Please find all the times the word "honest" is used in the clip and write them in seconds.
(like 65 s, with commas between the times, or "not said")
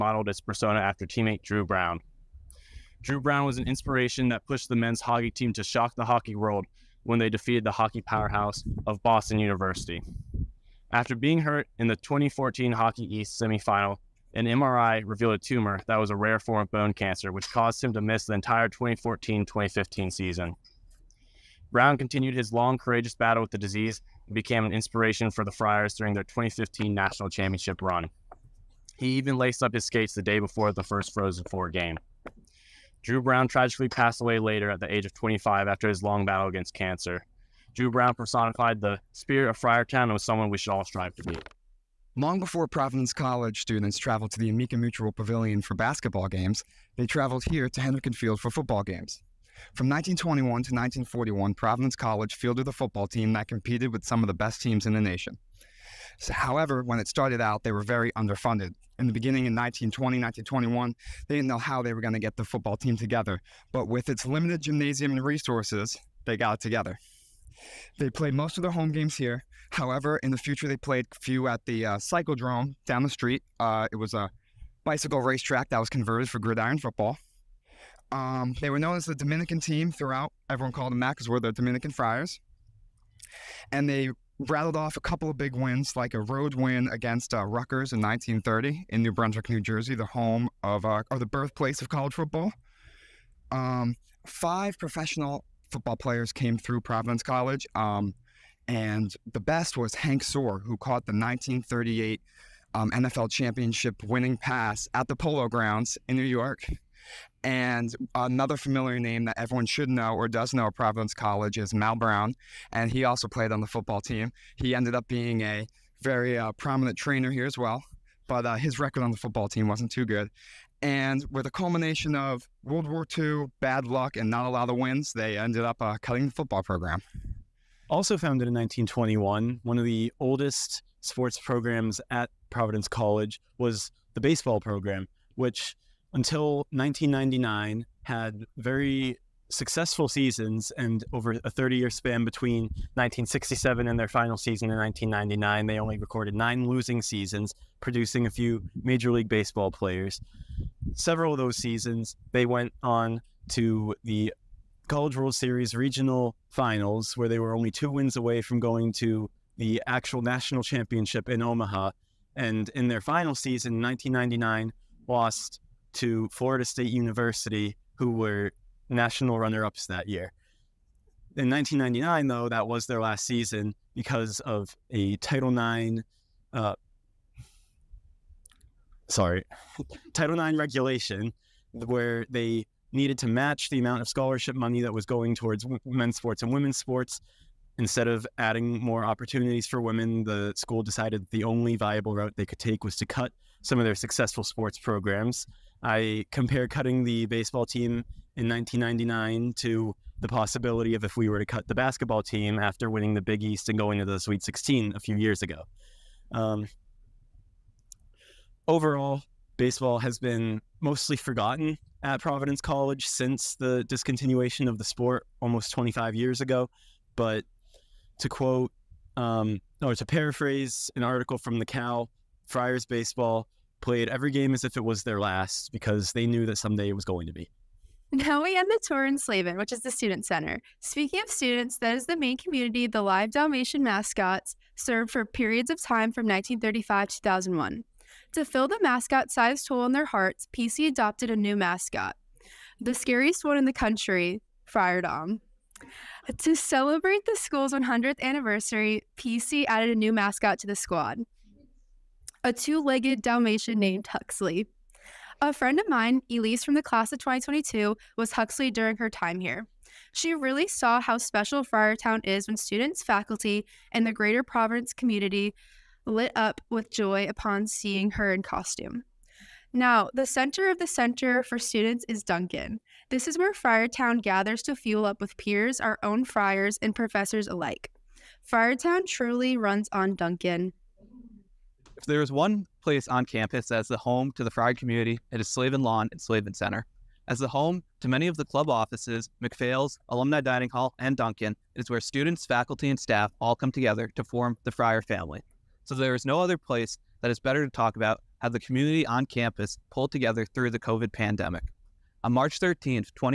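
not said.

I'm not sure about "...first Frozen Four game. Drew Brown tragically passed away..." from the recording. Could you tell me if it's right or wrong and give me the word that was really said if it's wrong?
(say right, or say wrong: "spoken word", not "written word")
right.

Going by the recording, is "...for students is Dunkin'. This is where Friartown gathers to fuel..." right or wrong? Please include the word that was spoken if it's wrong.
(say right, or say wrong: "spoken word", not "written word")
right.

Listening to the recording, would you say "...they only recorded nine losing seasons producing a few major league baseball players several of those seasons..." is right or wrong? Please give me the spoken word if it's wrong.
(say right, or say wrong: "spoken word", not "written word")
right.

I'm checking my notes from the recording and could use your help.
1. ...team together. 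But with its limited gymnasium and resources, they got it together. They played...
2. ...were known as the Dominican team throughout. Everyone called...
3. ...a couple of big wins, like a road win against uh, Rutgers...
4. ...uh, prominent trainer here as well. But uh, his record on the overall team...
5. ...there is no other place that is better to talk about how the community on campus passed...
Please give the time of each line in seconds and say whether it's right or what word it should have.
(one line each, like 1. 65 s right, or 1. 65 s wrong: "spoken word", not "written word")
1. 62 s right
2. 78 s right
3. 84 s right
4. 116 s wrong: "football", not "overall"
5. 295 s wrong: "pulled", not "passed".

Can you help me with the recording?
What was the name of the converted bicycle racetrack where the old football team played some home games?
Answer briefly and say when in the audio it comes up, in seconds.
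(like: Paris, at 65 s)
Cyclodrome, at 71 s.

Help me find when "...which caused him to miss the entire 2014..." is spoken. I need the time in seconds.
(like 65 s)
17 s.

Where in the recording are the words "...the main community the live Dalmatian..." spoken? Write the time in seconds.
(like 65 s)
232 s.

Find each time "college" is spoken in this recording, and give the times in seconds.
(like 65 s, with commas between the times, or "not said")
43 s, 51 s, 91 s, 97 s, 111 s, 132 s, 154 s, 212 s.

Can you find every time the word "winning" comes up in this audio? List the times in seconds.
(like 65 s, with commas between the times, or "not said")
104 s, 202 s.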